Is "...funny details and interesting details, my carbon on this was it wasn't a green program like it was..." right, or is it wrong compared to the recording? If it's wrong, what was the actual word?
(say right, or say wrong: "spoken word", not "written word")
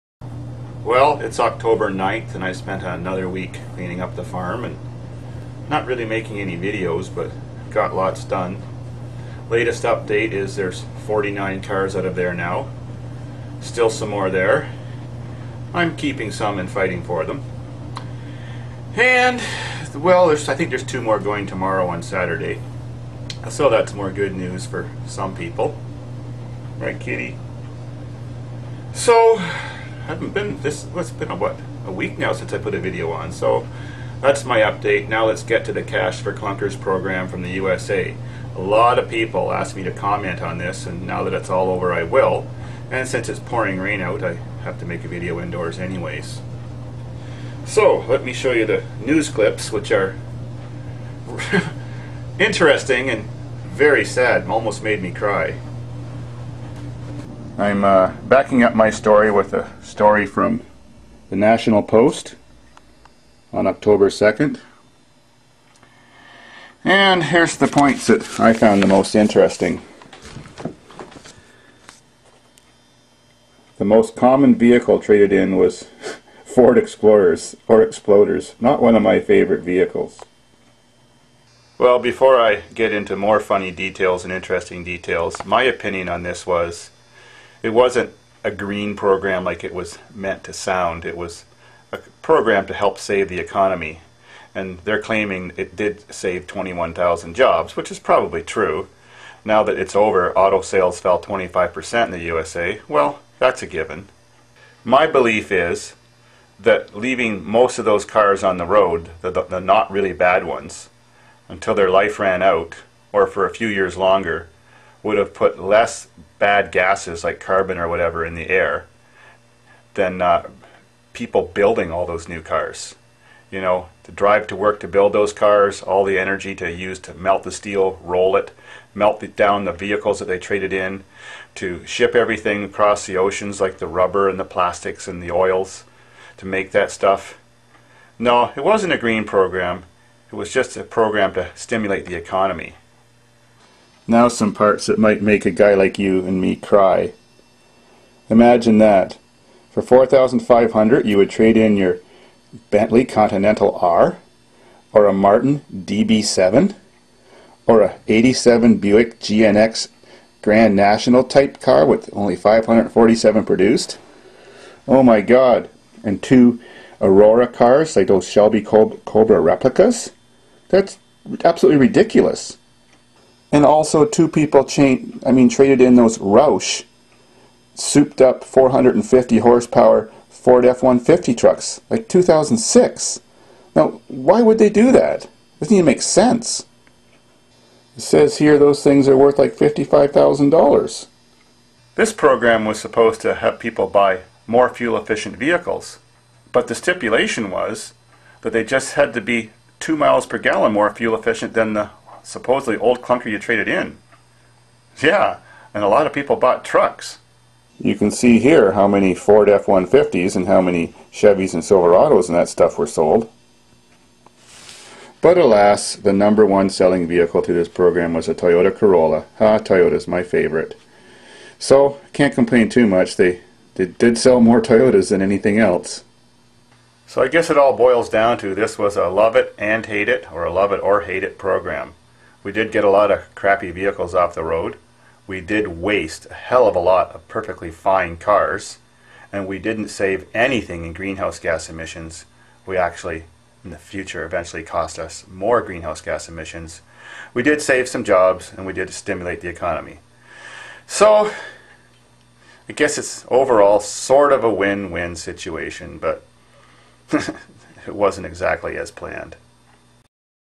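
wrong: "opinion", not "carbon".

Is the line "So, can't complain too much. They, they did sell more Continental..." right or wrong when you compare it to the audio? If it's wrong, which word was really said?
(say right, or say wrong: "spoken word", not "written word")
wrong: "Toyotas", not "Continental".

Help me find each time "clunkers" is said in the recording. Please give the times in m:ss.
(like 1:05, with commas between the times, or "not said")
0:36, 3:23.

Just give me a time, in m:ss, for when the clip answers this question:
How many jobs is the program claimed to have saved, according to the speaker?
1:36.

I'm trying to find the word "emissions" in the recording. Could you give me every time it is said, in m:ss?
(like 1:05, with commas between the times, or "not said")
4:01, 4:06.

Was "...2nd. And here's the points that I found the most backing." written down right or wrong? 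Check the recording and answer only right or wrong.
wrong.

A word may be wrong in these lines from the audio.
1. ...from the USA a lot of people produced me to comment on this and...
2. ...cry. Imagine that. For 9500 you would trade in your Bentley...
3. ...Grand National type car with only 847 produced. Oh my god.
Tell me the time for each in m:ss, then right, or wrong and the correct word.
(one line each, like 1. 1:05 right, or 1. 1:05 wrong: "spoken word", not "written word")
1. 0:37 wrong: "asked", not "produced"
2. 2:26 wrong: "4500", not "9500"
3. 2:40 wrong: "547", not "847".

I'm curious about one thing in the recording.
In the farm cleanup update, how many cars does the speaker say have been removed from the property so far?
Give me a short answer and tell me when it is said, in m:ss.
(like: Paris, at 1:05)
49, at 0:11.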